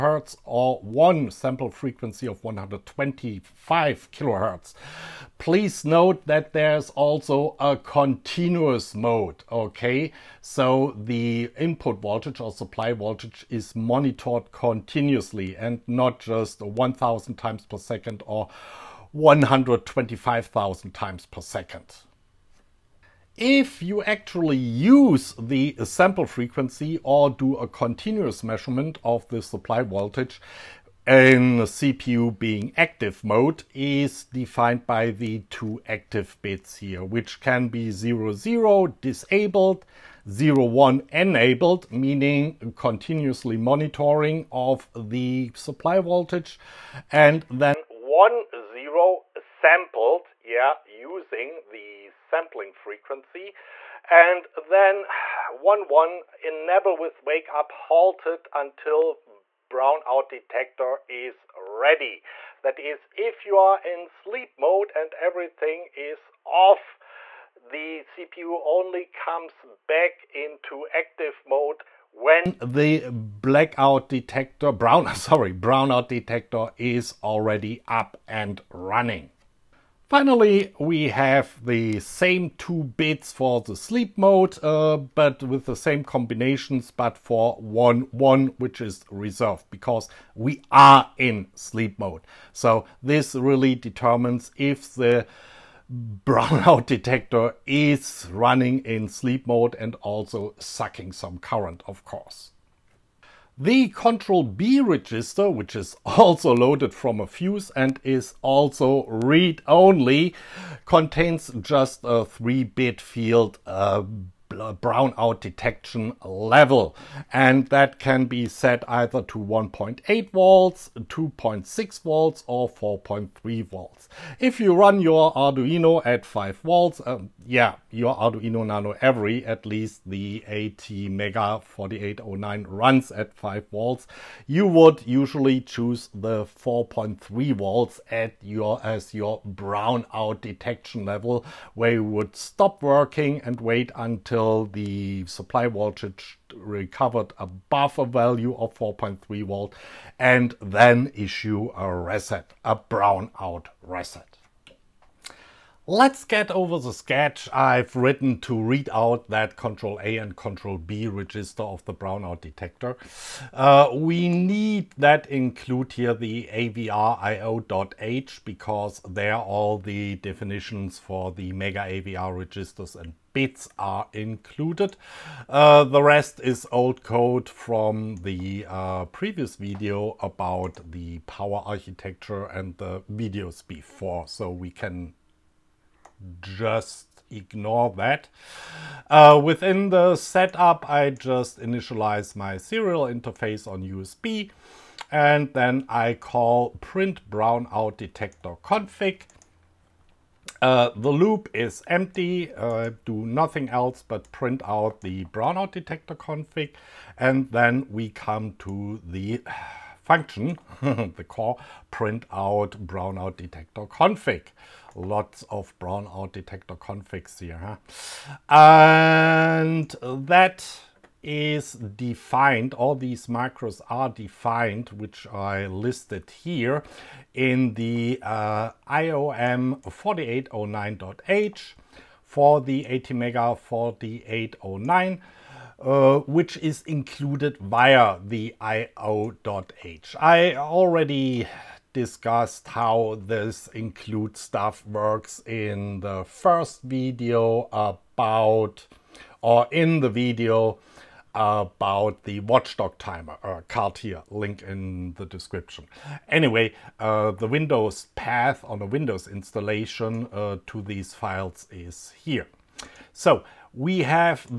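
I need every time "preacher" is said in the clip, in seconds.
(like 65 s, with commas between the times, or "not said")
not said.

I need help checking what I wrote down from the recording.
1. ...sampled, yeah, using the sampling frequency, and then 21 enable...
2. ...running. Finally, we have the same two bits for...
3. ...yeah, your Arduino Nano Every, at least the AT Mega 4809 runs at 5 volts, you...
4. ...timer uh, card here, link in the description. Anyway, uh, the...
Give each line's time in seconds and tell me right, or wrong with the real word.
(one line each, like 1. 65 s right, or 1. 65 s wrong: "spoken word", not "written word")
1. 49 s wrong: "11", not "21"
2. 78 s right
3. 127 s right
4. 252 s right.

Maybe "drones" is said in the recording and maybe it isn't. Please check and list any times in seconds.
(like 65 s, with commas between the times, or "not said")
not said.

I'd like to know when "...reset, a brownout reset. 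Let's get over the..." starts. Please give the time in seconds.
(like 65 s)
151 s.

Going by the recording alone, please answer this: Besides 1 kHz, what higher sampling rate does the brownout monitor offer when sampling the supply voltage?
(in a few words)
125 kHz.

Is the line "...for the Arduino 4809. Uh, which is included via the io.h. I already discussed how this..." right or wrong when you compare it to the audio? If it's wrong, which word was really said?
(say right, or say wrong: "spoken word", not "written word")
wrong: "ATmega", not "Arduino".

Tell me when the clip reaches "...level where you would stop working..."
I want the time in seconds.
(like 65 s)
141 s.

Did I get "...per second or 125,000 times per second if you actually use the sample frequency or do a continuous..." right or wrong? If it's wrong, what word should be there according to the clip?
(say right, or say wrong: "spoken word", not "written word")
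right.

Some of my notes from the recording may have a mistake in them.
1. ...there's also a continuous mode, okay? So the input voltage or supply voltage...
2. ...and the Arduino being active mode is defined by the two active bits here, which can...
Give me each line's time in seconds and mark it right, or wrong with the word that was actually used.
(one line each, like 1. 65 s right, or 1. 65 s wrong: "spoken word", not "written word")
1. 6 s right
2. 31 s wrong: "CPU", not "Arduino".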